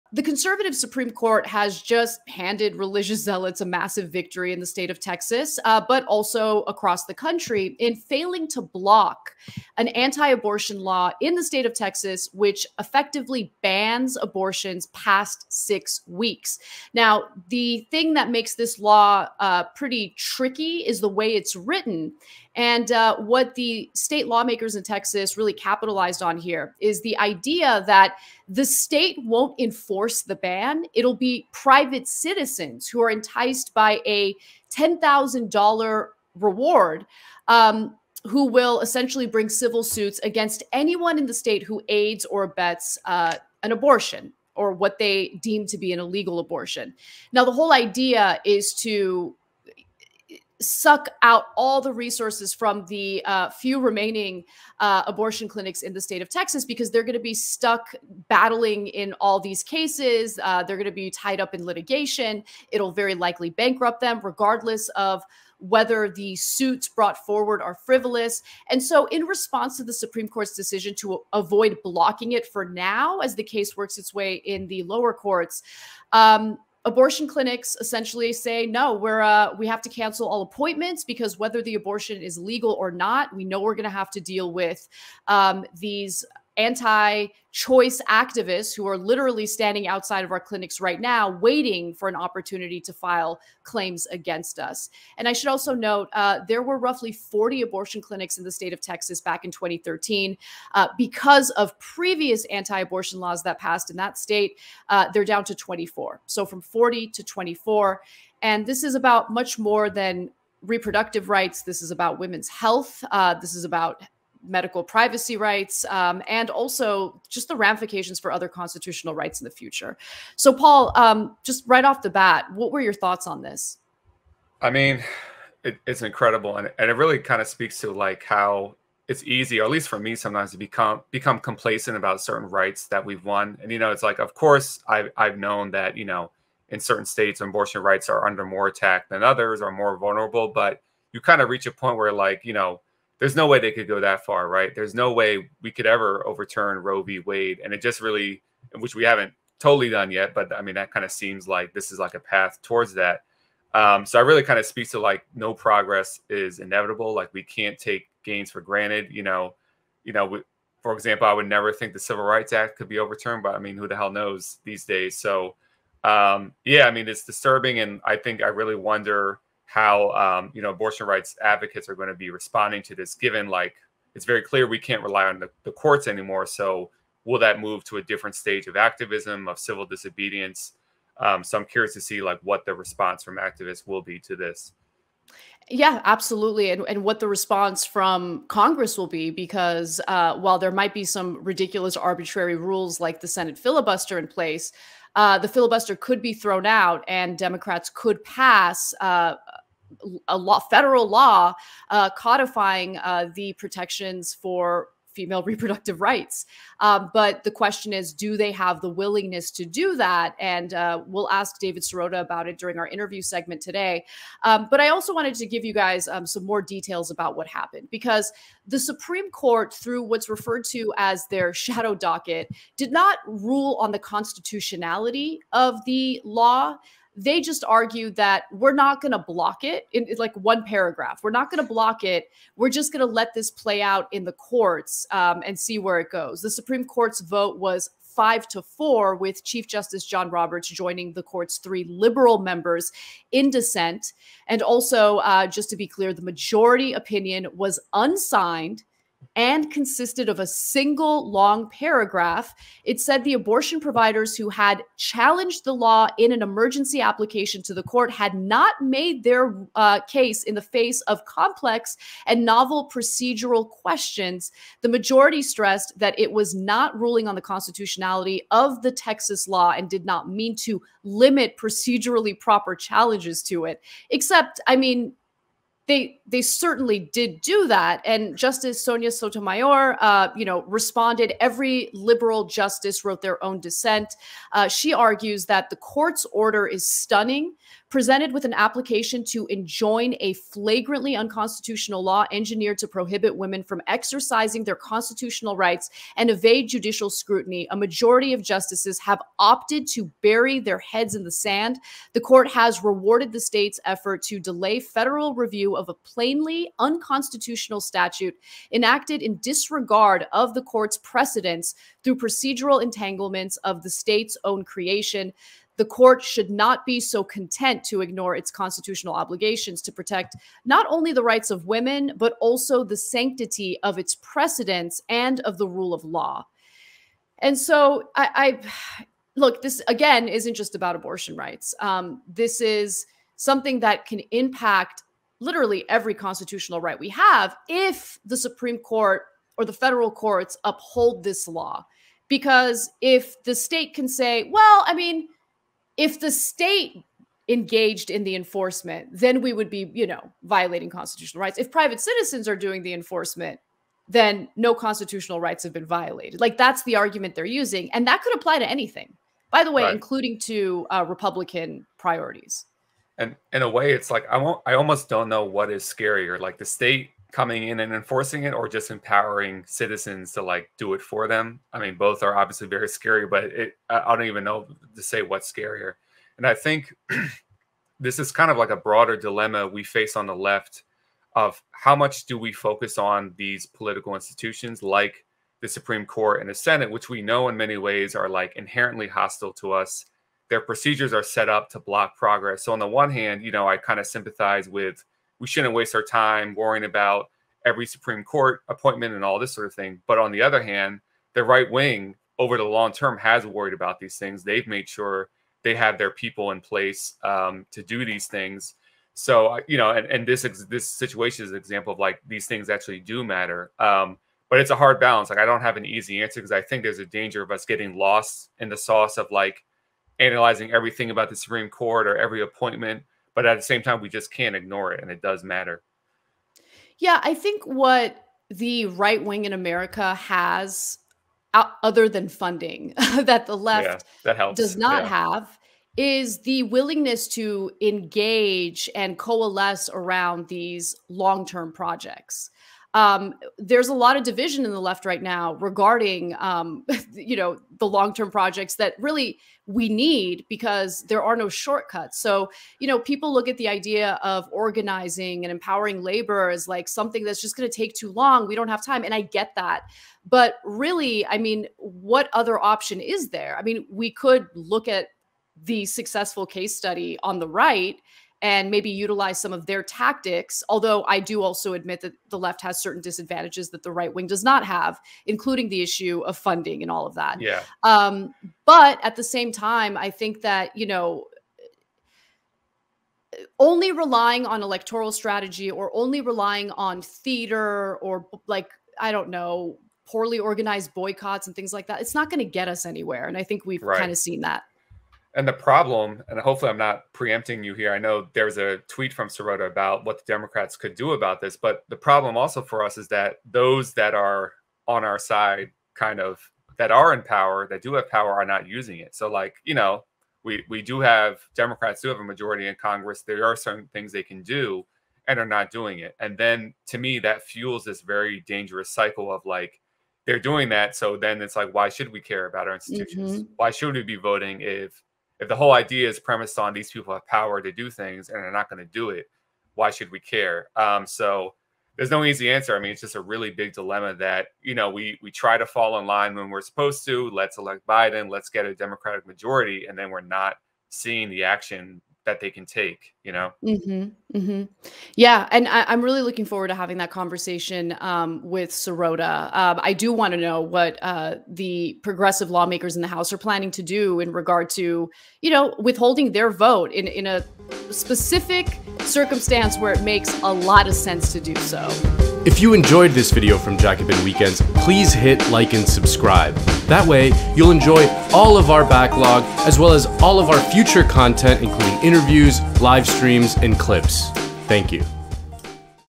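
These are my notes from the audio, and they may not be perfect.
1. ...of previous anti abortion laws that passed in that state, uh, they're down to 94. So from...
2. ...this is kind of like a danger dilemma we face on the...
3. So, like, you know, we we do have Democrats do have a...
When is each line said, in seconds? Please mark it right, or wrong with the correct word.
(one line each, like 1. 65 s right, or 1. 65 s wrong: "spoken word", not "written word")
1. 101 s wrong: "24", not "94"
2. 377 s wrong: "broader", not "danger"
3. 509 s right.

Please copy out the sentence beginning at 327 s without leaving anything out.
And so I, I look, this again isn't just about abortion rights.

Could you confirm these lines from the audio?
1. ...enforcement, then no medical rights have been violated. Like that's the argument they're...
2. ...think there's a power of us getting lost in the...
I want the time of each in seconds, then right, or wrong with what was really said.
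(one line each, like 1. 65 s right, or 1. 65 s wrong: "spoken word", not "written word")
1. 352 s wrong: "constitutional", not "medical"
2. 416 s wrong: "danger", not "power".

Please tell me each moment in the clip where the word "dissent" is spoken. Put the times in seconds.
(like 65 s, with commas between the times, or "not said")
243 s, 283 s.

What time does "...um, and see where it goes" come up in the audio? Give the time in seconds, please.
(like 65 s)
235 s.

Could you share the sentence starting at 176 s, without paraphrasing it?
So will that move to a different stage of activism of civil disobedience?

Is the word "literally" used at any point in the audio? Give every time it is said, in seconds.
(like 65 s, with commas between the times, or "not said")
88 s, 335 s.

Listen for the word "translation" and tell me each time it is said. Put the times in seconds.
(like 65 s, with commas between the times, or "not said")
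not said.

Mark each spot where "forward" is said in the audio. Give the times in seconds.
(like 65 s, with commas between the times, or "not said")
67 s, 546 s.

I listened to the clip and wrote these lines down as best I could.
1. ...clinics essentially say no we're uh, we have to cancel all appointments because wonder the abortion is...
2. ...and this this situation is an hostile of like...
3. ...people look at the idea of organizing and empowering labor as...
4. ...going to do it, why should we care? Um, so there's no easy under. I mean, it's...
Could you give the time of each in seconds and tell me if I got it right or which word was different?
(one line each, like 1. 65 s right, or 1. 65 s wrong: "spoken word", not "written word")
1. 77 s wrong: "whether", not "wonder"
2. 410 s wrong: "example", not "hostile"
3. 452 s right
4. 528 s wrong: "answer", not "under".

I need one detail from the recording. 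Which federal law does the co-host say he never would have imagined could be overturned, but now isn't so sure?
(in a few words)
Civil Rights Act.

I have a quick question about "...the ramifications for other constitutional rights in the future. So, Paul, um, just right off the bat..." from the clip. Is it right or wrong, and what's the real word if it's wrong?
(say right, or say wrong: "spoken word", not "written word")
right.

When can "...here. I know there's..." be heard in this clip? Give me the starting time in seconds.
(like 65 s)
497 s.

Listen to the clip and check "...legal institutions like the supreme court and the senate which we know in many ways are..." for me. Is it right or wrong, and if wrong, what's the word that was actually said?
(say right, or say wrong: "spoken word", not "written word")
wrong: "political", not "legal".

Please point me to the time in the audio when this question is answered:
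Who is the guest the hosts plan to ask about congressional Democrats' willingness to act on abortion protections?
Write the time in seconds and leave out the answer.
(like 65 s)
211 s.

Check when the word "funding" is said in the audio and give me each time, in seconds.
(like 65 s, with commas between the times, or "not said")
432 s, 476 s.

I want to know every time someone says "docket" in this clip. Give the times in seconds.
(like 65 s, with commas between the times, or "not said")
221 s.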